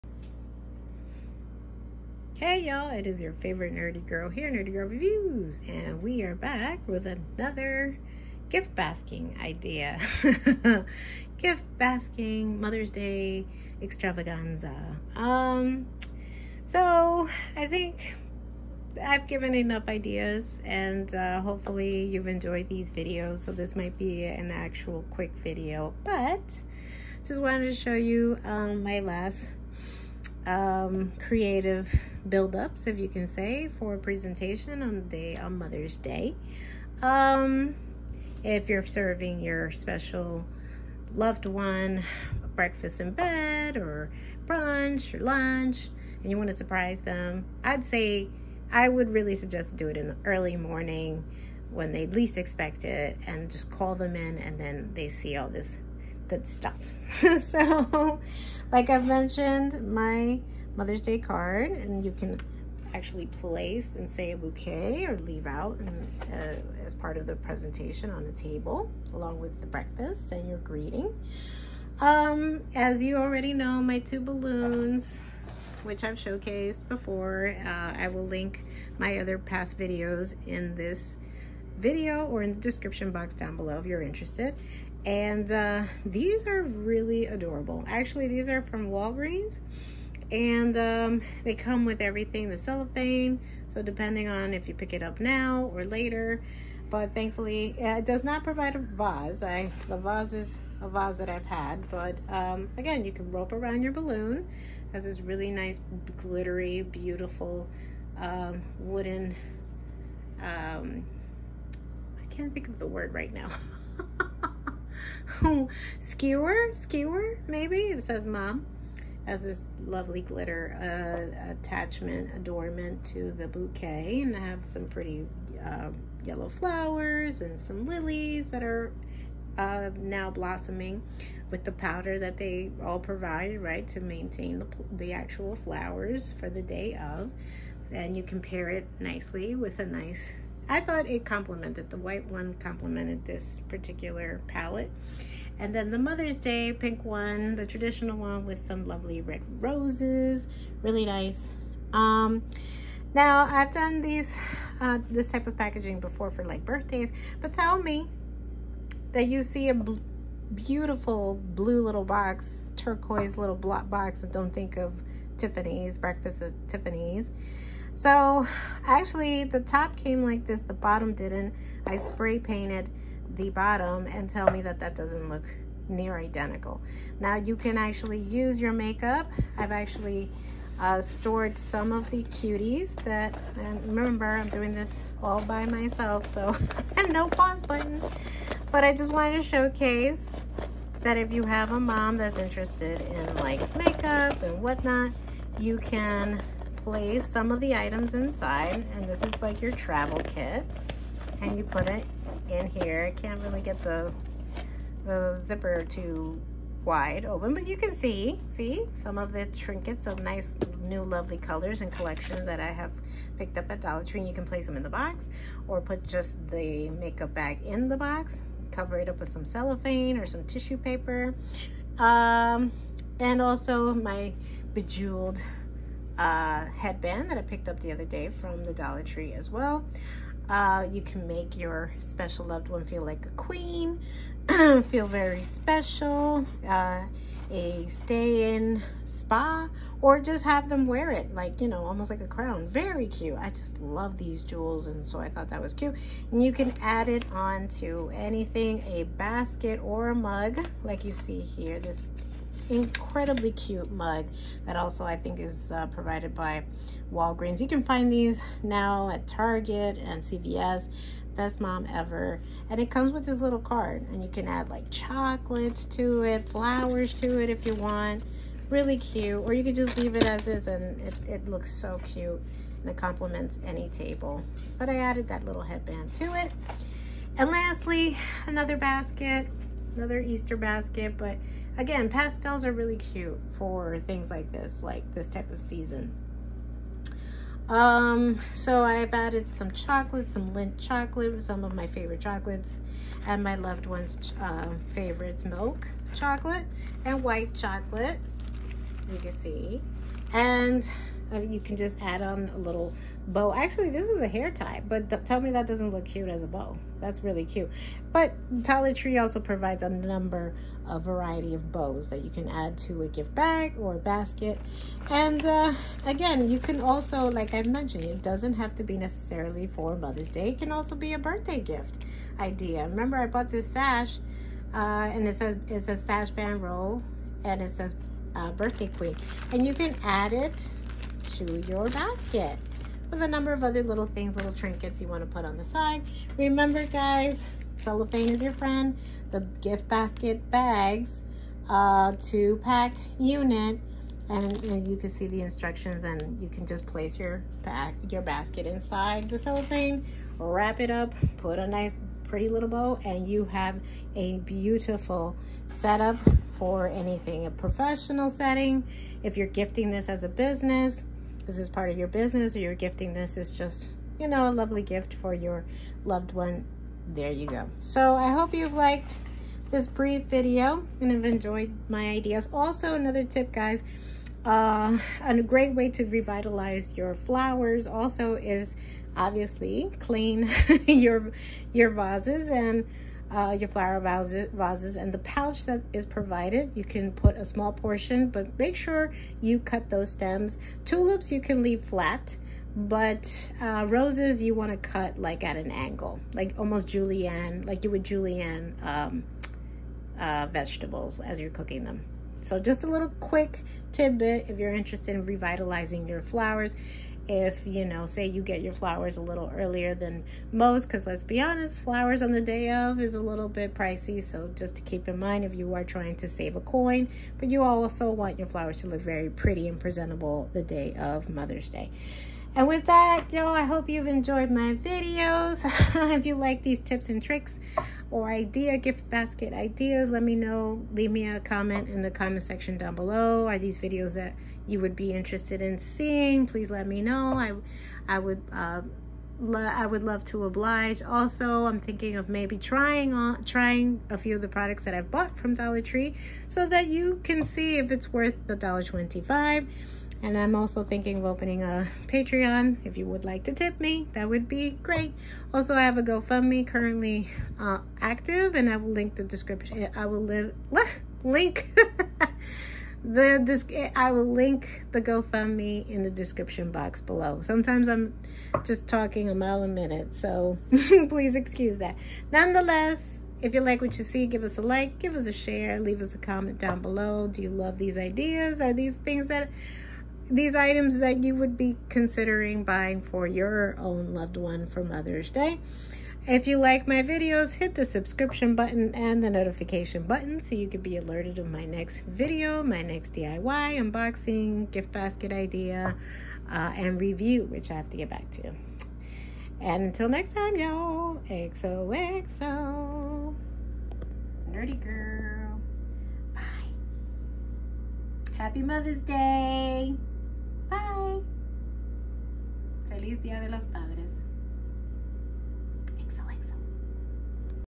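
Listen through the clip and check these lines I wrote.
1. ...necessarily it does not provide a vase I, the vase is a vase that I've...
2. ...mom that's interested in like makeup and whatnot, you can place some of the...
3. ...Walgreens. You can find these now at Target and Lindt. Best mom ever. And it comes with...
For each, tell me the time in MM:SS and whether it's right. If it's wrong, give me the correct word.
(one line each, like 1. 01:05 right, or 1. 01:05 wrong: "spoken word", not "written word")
1. 01:37 wrong: "thankfully", not "necessarily"
2. 03:11 right
3. 04:17 wrong: "CVS", not "Lindt".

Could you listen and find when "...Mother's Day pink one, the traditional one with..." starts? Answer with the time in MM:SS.
02:25.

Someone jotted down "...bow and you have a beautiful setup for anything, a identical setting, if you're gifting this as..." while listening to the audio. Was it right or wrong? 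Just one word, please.
wrong.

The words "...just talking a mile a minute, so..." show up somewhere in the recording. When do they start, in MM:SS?
07:48.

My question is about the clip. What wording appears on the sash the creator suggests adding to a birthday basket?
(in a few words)
Birthday queen.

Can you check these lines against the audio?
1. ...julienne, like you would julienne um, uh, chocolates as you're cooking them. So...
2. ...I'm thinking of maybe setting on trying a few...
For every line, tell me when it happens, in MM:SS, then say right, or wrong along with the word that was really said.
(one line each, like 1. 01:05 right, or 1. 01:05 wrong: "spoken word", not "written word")
1. 06:36 wrong: "vegetables", not "chocolates"
2. 07:21 wrong: "trying", not "setting".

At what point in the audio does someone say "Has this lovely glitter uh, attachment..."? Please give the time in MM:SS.
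01:59.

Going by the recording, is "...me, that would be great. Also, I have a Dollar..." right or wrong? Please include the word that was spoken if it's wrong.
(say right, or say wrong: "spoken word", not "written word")
wrong: "GoFundMe", not "Dollar".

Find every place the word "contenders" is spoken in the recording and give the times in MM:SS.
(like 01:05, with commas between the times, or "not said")
not said.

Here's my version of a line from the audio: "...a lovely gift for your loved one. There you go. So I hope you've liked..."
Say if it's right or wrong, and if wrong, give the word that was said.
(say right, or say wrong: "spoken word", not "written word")
right.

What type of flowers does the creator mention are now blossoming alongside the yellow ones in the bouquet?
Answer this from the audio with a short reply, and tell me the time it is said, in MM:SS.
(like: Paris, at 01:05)
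Lilies, at 02:07.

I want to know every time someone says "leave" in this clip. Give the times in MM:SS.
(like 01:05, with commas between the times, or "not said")
01:05, 04:29, 06:31, 07:10, 07:55.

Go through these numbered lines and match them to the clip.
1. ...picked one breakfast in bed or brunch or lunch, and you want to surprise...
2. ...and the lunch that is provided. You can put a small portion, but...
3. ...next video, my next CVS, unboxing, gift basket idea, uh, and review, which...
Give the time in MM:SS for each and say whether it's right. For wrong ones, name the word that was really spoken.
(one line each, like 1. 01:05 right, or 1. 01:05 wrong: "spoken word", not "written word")
1. 00:41 wrong: "loved", not "picked"
2. 06:24 wrong: "pouch", not "lunch"
3. 08:11 wrong: "DIY", not "CVS".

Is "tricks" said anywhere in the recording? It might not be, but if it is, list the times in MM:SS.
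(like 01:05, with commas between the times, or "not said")
07:07.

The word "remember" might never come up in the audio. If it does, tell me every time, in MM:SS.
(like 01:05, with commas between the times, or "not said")
03:03, 05:22, 05:36.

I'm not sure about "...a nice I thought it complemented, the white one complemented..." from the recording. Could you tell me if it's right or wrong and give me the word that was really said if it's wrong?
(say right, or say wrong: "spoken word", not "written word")
right.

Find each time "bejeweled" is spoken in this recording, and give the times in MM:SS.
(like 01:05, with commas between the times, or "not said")
03:44.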